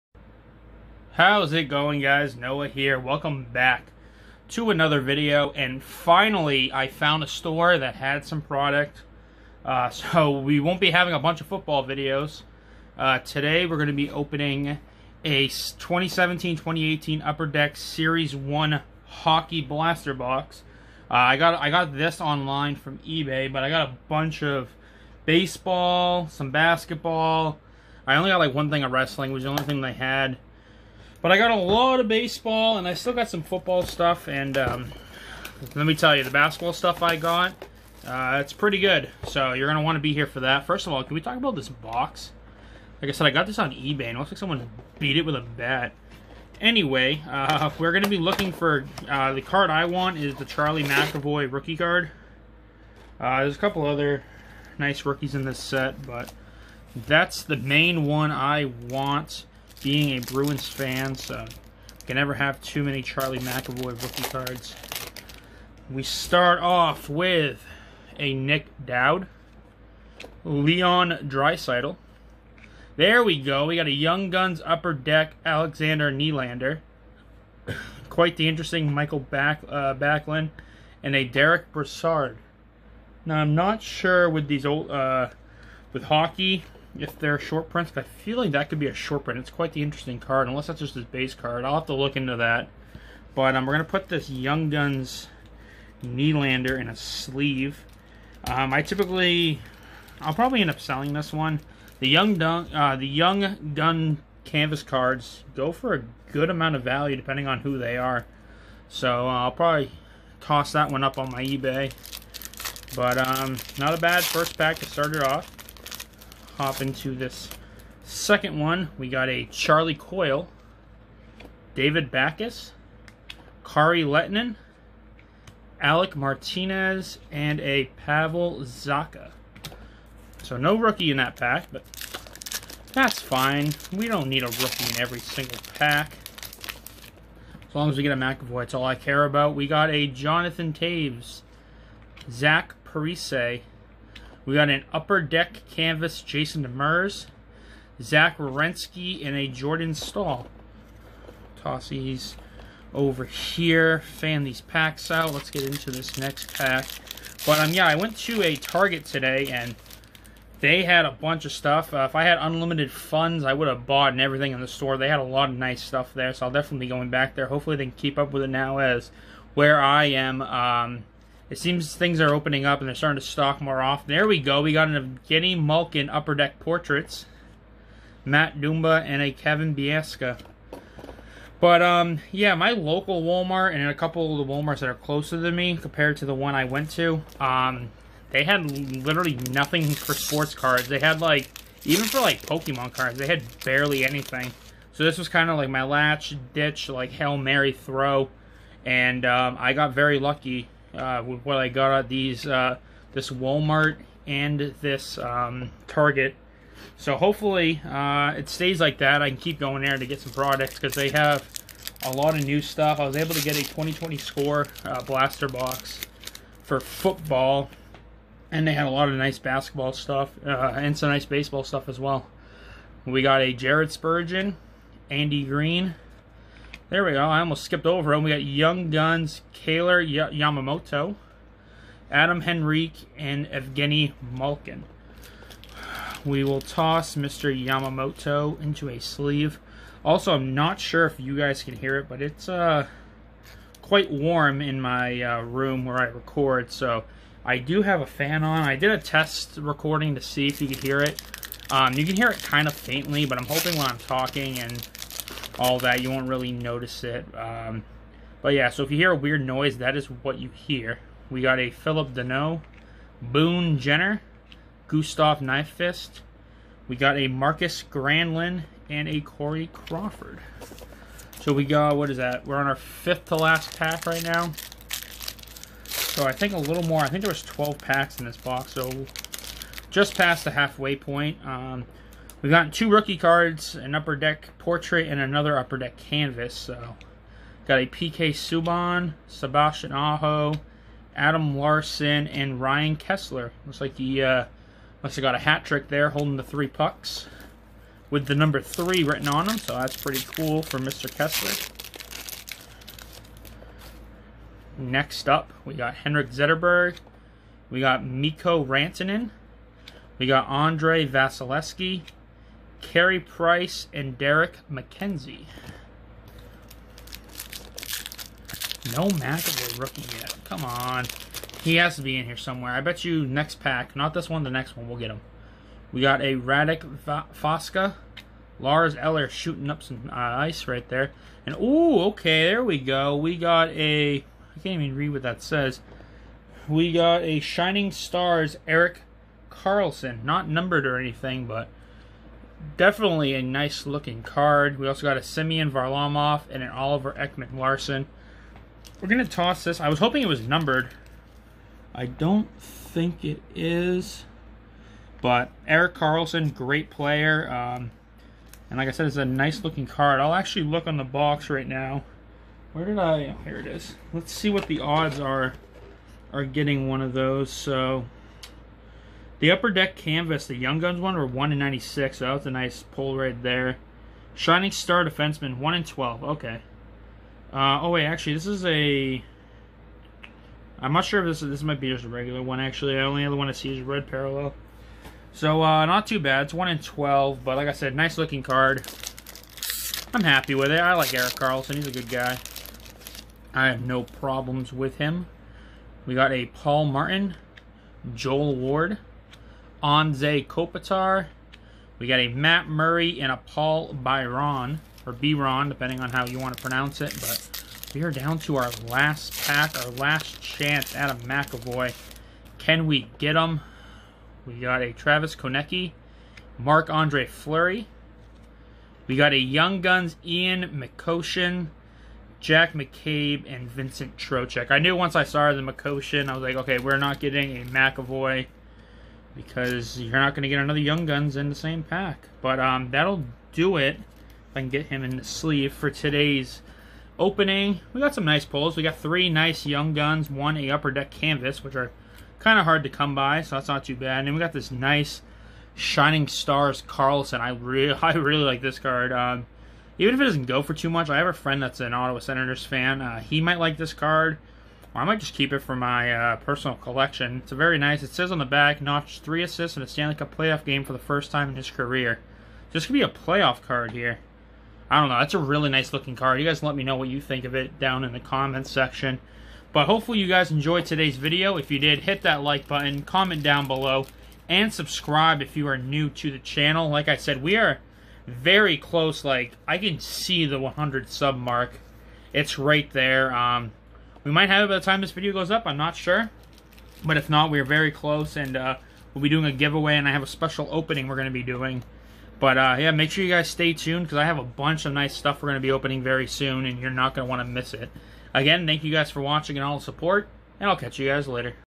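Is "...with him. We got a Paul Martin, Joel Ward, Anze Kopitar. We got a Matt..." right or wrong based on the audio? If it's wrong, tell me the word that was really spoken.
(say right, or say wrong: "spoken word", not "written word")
right.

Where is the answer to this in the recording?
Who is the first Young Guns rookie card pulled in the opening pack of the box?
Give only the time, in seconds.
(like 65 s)
75 s.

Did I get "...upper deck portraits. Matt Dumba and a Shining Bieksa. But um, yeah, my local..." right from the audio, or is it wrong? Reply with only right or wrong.
wrong.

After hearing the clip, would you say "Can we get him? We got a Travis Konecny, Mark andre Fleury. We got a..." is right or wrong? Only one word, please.
right.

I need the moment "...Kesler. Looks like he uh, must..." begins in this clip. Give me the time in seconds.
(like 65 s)
292 s.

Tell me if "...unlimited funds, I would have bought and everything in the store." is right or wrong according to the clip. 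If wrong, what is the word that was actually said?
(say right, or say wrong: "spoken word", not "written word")
right.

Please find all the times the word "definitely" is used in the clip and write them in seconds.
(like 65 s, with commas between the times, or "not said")
166 s, 342 s.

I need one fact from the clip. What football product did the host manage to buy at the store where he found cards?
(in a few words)
2020 Score blaster box.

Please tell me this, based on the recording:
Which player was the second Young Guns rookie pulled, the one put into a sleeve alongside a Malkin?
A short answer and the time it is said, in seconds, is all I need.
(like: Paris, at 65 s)
Kailer Yamamoto, at 229 s.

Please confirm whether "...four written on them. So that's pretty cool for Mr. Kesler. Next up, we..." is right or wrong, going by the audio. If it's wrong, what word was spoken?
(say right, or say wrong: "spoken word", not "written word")
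wrong: "three", not "four".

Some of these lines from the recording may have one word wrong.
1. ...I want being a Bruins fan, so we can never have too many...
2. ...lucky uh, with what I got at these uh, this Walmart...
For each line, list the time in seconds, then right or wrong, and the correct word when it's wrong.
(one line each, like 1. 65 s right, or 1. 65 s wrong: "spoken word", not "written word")
1. 58 s right
2. 200 s right.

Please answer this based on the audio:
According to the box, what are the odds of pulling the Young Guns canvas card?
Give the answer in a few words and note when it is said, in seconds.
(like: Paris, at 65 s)
1 in 96, at 371 s.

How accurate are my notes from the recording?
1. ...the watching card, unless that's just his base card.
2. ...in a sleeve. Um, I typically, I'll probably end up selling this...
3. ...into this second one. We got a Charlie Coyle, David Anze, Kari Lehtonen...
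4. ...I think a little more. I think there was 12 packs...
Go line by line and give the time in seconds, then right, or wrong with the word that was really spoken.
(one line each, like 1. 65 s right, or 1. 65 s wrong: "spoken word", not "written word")
1. 89 s wrong: "interesting", not "watching"
2. 96 s right
3. 116 s wrong: "Backes", not "Anze"
4. 276 s right.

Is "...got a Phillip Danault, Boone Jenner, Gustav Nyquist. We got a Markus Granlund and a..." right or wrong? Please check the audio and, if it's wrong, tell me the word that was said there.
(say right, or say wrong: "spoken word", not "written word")
right.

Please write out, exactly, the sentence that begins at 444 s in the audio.
And then we got this nice Shining Stars Karlsson.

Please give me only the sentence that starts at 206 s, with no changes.
So hopefully uh, it stays like that.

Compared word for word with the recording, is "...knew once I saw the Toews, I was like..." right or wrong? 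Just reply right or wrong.
wrong.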